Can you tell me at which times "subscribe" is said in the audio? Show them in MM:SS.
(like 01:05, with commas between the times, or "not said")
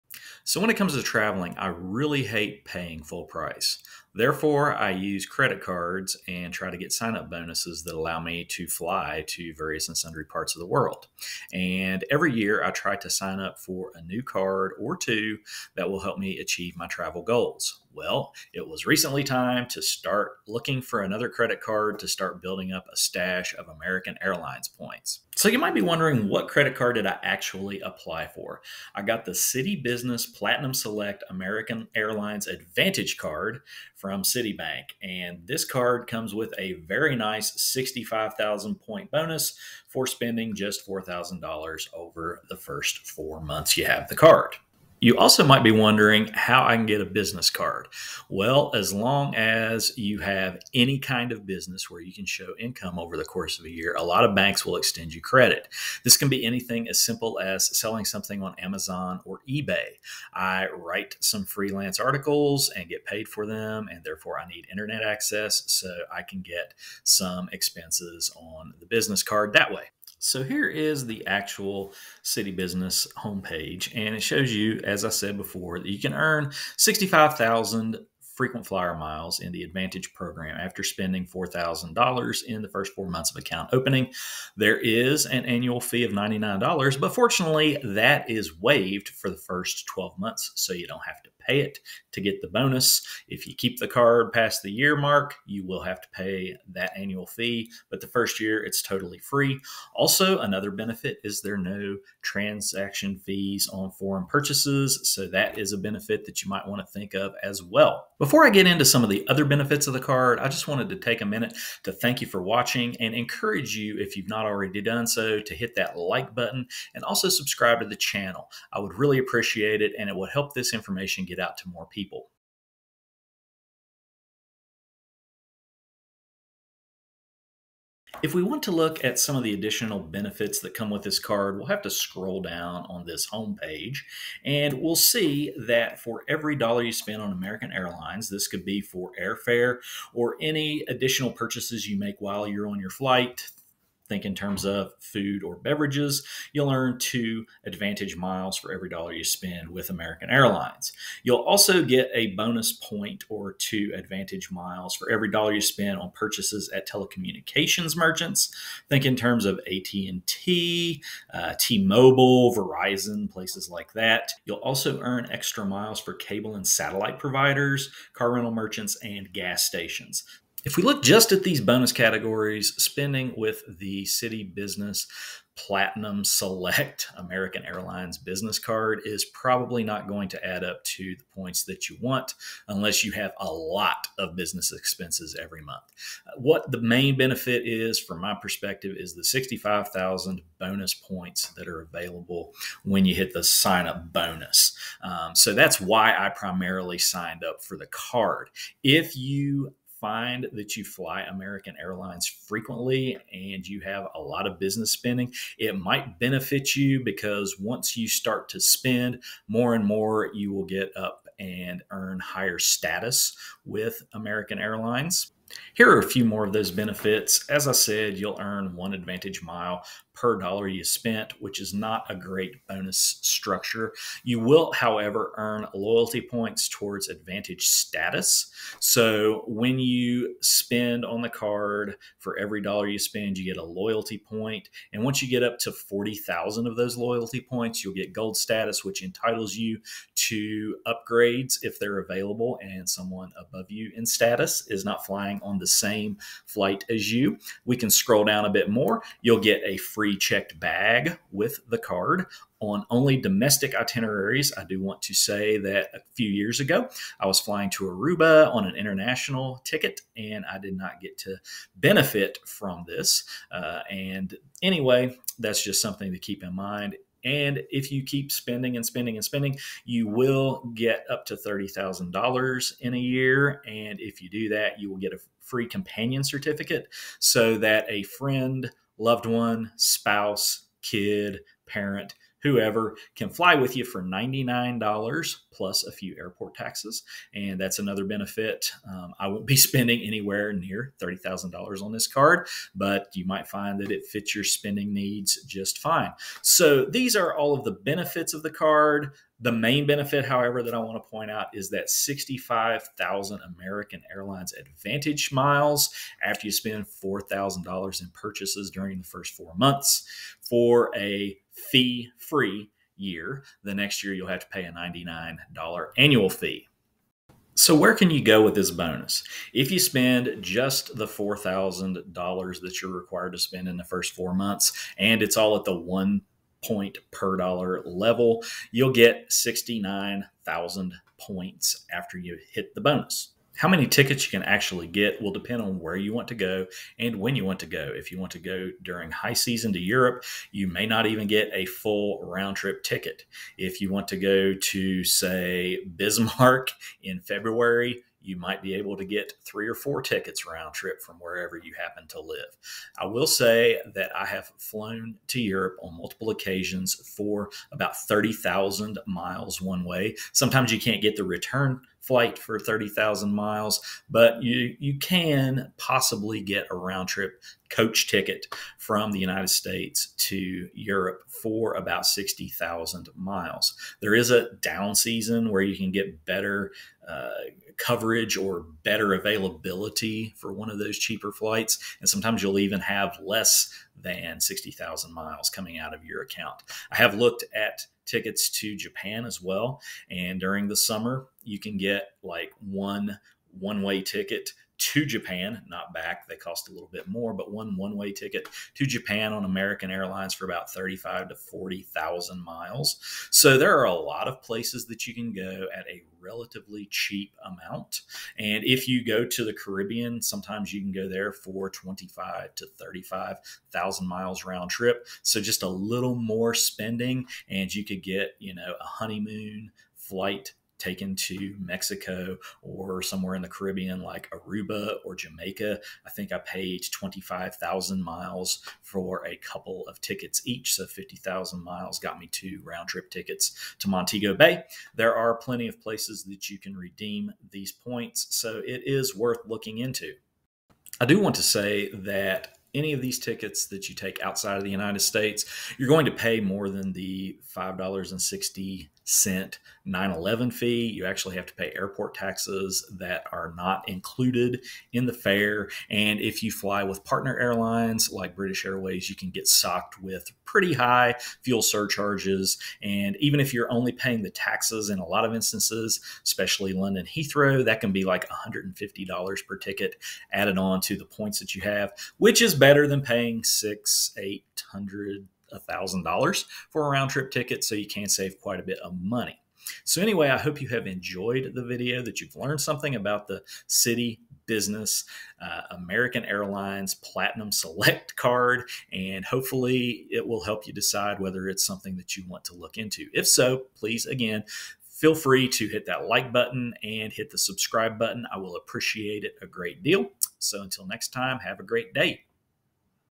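01:57, 08:17.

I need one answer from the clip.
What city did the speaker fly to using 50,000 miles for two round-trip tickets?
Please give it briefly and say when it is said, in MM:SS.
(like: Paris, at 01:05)
Montego Bay, at 07:13.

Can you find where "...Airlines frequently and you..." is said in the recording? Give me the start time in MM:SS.
03:21.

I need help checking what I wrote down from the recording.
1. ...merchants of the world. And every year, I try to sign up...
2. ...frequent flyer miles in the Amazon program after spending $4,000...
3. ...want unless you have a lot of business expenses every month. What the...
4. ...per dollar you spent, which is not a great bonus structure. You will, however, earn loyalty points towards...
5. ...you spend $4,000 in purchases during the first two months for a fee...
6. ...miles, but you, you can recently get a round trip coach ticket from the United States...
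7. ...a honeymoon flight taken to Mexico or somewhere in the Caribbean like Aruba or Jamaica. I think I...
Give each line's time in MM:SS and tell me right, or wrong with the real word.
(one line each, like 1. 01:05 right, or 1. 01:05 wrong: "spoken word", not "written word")
1. 00:10 wrong: "parts", not "merchants"
2. 01:18 wrong: "AAdvantage", not "Amazon"
3. 03:01 right
4. 03:40 right
5. 05:06 wrong: "four", not "two"
6. 06:03 wrong: "possibly", not "recently"
7. 06:58 right.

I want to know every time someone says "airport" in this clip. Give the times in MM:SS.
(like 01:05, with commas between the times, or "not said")
04:46, 07:31.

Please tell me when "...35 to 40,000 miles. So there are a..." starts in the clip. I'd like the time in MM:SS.
06:40.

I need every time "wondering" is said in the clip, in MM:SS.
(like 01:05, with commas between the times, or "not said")
00:25, 00:45.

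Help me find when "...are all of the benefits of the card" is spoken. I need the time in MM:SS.
04:57.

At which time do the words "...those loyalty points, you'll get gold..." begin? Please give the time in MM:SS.
03:56.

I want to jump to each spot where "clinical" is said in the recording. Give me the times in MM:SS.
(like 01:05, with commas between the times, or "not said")
not said.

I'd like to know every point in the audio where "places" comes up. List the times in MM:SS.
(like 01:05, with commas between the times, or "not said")
02:43, 06:44, 07:15.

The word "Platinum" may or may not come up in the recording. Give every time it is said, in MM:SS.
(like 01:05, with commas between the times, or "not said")
00:30, 02:55, 08:06.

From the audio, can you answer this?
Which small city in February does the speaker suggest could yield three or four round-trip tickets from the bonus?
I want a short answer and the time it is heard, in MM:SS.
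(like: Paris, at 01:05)
Bismarck, at 05:45.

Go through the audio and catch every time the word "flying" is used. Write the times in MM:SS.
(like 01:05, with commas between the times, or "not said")
04:05, 04:17.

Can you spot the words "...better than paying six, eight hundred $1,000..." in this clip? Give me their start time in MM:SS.
07:52.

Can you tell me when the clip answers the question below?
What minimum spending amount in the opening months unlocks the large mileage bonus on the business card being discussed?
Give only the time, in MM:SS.
00:40.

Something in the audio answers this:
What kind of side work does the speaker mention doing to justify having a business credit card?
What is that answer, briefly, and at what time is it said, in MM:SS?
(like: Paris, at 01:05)
freelance articles, at 01:01.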